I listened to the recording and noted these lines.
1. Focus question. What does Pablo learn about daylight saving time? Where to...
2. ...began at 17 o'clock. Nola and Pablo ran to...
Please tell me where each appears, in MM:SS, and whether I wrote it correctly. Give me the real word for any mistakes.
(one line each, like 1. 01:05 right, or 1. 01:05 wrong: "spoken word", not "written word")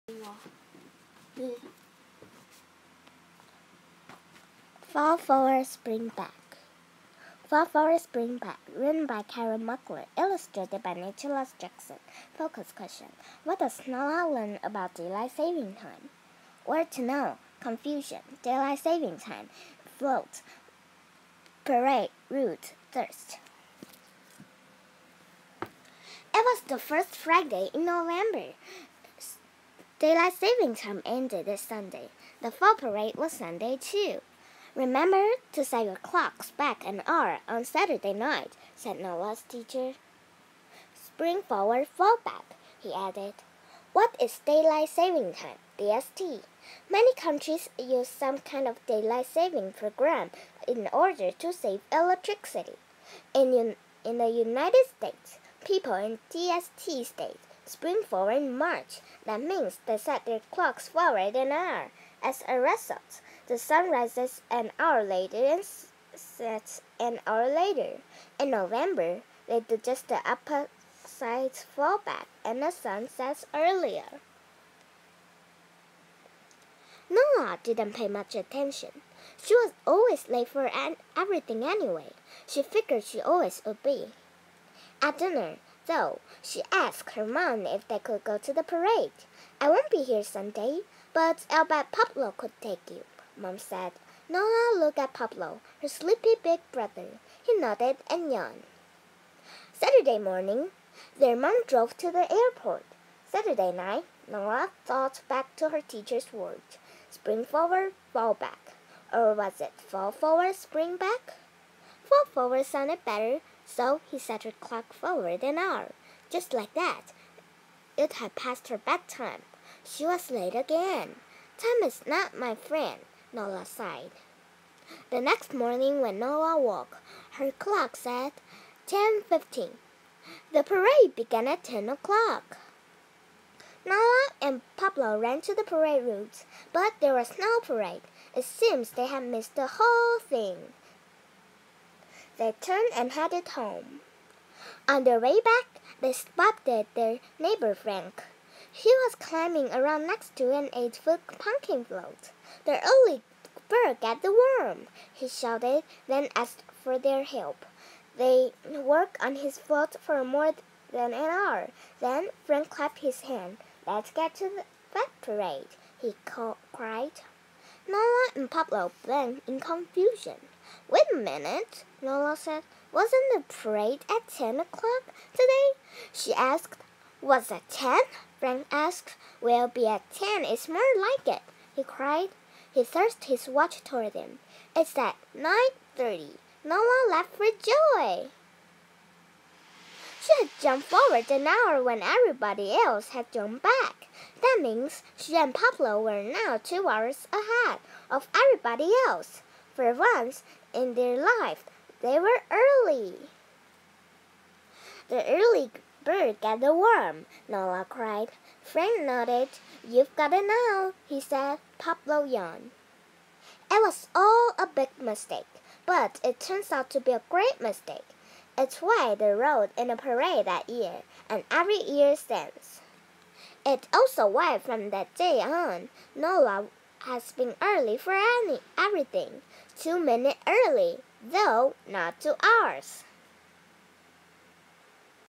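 1. 00:12 wrong: "Snow", not "Pablo"
2. 02:11 wrong: "10", not "17".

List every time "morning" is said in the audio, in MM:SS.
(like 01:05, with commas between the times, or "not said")
01:40, 02:05.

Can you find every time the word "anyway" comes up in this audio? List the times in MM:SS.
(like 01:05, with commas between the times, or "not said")
01:21.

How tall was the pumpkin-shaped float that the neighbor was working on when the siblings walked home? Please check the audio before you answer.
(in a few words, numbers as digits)
8 feet.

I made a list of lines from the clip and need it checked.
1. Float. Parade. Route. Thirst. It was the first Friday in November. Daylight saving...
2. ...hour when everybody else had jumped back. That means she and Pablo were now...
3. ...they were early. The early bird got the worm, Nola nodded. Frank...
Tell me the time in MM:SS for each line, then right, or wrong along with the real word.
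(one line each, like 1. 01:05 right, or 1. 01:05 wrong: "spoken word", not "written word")
1. 00:19 right
2. 03:11 right
3. 03:22 wrong: "cried", not "nodded".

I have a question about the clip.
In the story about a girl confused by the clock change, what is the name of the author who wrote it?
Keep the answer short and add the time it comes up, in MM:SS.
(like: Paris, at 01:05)
Karen Muckler, at 00:09.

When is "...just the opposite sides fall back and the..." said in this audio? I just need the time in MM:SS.
01:09.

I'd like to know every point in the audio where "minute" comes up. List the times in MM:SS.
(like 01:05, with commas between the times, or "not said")
02:51, 03:49.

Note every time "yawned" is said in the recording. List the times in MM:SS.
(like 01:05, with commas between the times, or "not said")
01:38, 03:32.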